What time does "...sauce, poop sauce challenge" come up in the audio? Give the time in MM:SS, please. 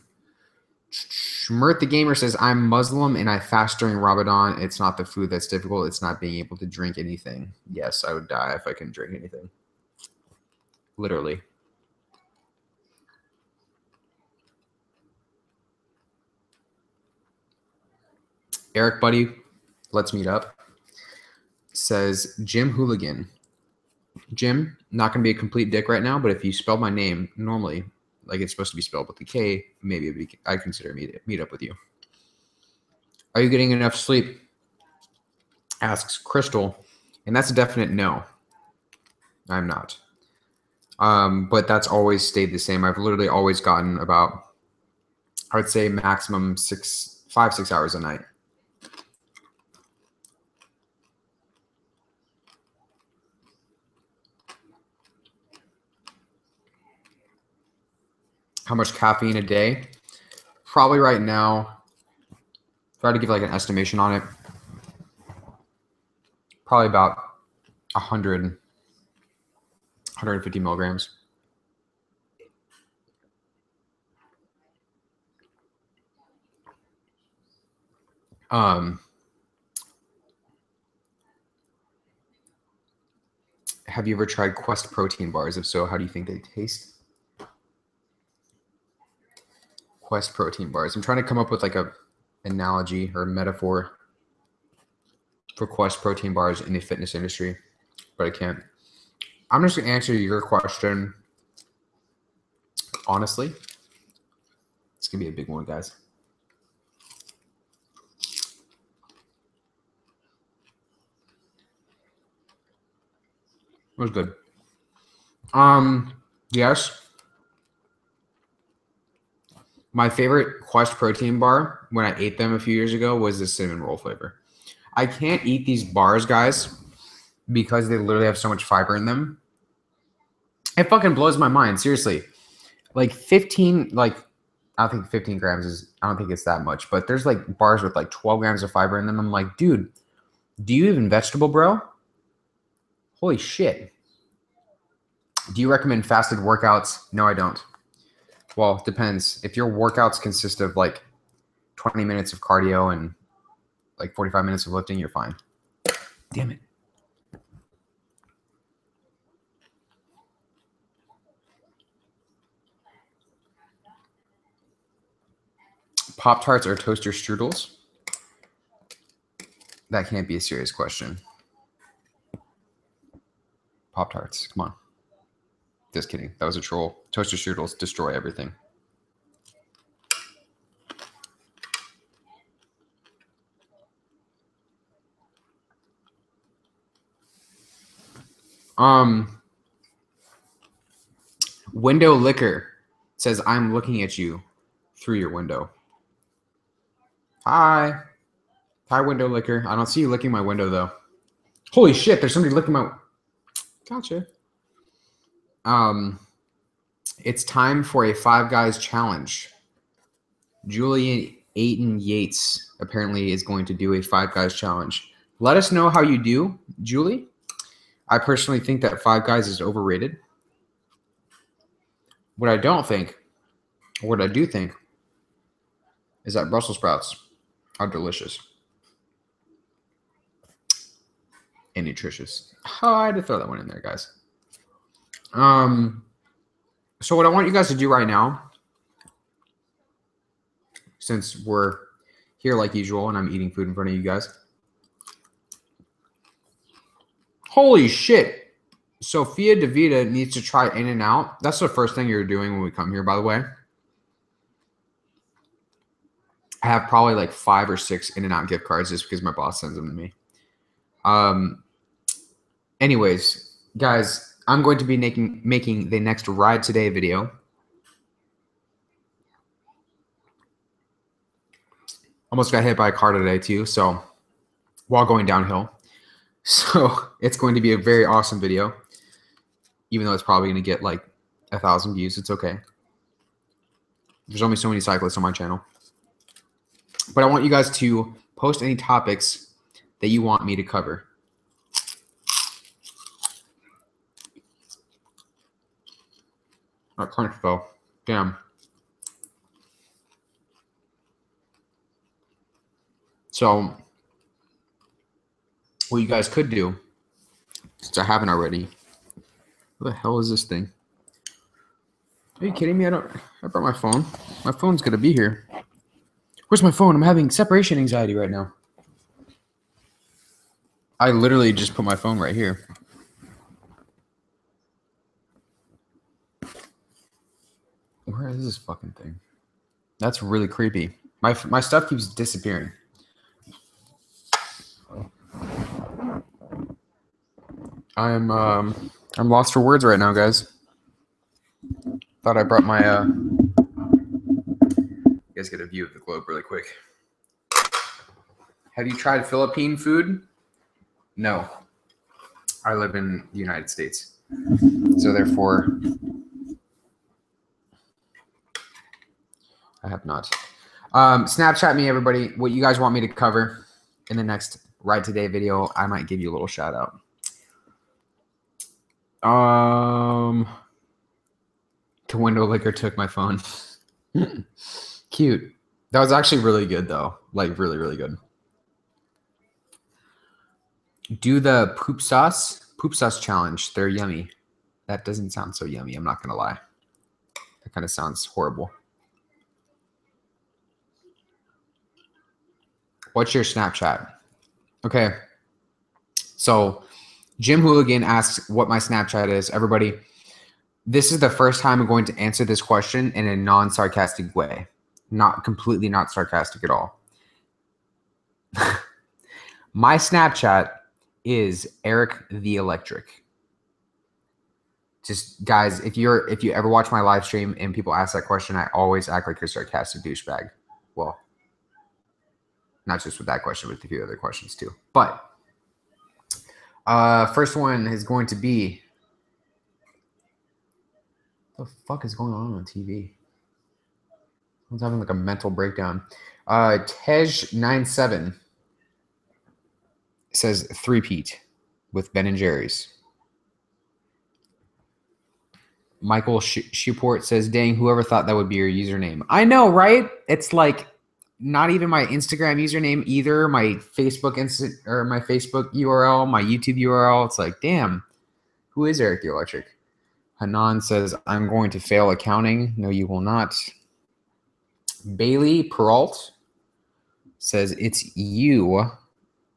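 06:22.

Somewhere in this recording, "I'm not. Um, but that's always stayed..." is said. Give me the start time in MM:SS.
00:39.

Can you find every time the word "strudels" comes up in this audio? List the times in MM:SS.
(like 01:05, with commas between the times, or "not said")
02:47, 02:57.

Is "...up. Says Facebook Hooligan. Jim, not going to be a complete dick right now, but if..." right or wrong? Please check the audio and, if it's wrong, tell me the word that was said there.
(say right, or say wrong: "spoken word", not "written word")
wrong: "Jim", not "Facebook".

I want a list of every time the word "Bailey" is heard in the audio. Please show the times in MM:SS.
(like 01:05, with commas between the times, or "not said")
07:45.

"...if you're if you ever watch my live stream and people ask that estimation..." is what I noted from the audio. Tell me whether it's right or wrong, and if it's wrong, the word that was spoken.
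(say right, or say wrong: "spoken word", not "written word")
wrong: "question", not "estimation".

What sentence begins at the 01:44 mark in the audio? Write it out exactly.
It's gonna be a big one, guys.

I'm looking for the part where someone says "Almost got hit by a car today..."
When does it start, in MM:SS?
04:32.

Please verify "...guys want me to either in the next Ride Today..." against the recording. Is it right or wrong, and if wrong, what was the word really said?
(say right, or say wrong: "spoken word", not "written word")
wrong: "cover", not "either".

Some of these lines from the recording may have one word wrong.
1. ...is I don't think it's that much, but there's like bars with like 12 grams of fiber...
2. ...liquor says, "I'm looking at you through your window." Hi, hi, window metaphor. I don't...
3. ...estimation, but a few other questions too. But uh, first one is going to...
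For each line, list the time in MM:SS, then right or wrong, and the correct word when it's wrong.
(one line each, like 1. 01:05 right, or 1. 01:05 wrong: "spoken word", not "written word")
1. 02:15 right
2. 03:12 wrong: "liquor", not "metaphor"
3. 07:03 wrong: "question", not "estimation".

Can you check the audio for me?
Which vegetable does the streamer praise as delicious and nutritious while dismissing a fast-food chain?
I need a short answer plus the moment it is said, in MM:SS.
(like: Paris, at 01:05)
Brussels sprouts, at 03:46.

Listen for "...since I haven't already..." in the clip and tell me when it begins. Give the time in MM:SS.
05:07.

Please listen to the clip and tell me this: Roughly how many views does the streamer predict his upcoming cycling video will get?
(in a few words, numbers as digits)
1,000.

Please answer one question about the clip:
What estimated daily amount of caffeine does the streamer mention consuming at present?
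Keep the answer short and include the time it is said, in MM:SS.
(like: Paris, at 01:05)
100-150 milligrams, at 01:07.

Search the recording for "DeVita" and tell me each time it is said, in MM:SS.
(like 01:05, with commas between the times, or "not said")
04:09.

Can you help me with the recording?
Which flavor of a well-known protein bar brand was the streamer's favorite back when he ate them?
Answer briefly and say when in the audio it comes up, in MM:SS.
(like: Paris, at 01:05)
Cinnamon roll, at 02:03.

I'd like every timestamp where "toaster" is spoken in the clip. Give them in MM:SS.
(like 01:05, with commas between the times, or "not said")
02:46, 02:57.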